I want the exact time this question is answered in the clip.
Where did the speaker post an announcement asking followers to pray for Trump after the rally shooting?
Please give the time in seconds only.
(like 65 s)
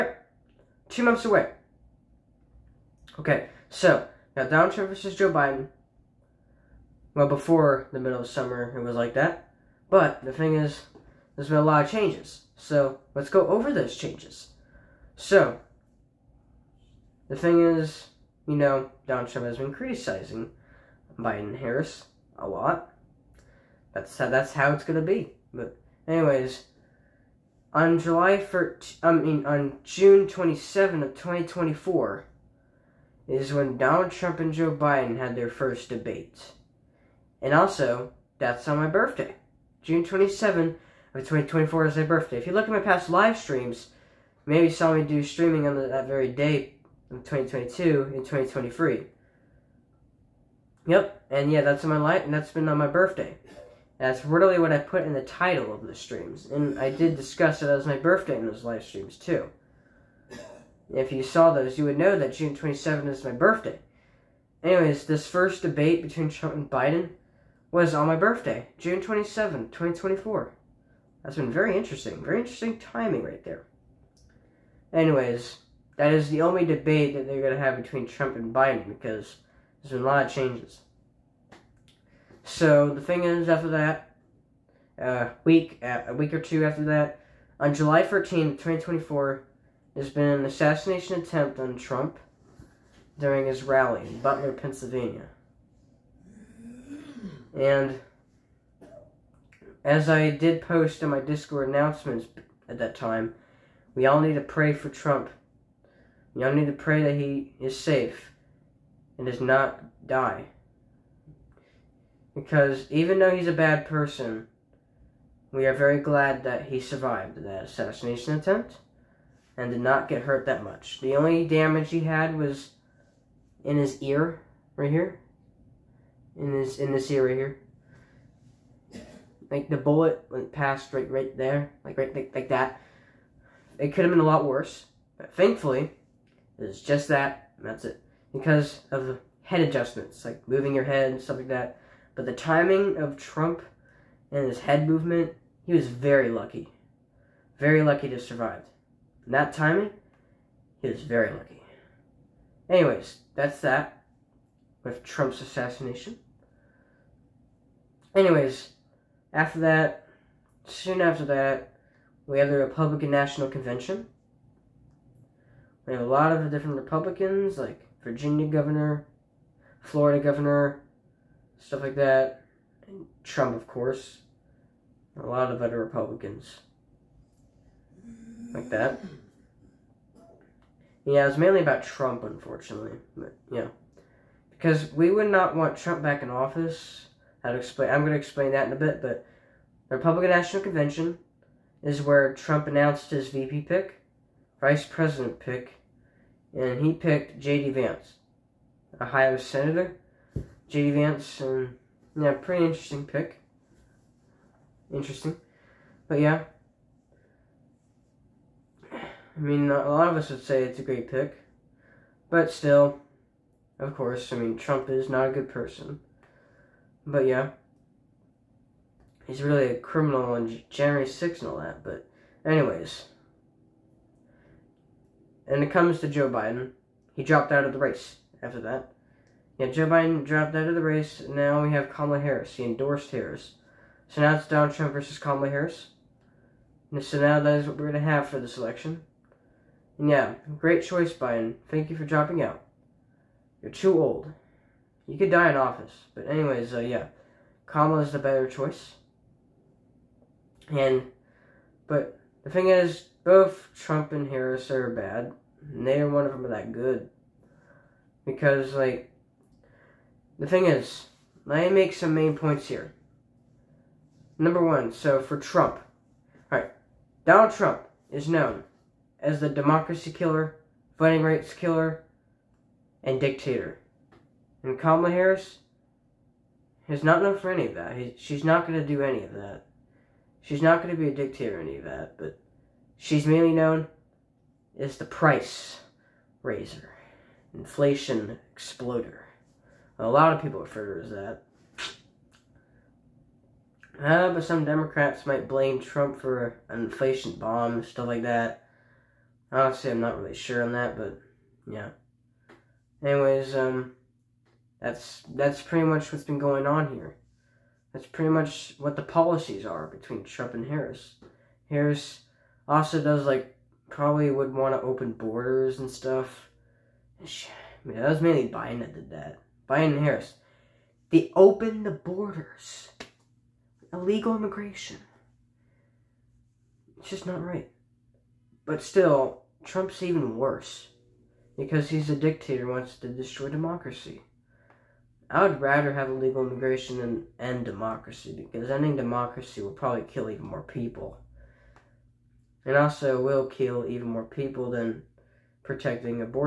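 101 s.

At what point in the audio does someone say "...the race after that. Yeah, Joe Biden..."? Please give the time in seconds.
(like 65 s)
227 s.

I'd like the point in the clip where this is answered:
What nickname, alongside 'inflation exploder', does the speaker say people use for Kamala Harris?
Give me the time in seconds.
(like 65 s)
285 s.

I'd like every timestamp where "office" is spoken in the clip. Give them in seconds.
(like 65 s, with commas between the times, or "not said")
186 s, 245 s.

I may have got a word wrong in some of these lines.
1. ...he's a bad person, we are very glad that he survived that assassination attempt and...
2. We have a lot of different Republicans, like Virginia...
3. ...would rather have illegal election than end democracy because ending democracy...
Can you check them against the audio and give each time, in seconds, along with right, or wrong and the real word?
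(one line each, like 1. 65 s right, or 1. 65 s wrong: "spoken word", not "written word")
1. 113 s right
2. 165 s right
3. 335 s wrong: "immigration", not "election".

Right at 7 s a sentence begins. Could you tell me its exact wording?
Well, before the middle of summer, it was like that.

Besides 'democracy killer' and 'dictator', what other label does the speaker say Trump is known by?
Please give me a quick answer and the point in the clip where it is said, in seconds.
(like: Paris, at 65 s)
Voting rights killer, at 270 s.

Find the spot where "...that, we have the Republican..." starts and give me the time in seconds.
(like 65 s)
161 s.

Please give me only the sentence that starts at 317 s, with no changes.
I mean, that was mainly Biden that did that.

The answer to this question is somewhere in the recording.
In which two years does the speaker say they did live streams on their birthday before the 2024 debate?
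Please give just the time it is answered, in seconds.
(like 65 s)
47 s.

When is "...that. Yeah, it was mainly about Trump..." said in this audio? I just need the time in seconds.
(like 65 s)
178 s.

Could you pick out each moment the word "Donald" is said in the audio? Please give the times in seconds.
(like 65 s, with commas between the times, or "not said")
4 s, 19 s, 33 s, 234 s, 267 s.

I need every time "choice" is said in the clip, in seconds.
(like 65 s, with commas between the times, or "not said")
240 s, 248 s.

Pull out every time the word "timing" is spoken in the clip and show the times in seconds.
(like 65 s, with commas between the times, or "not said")
72 s, 142 s, 149 s.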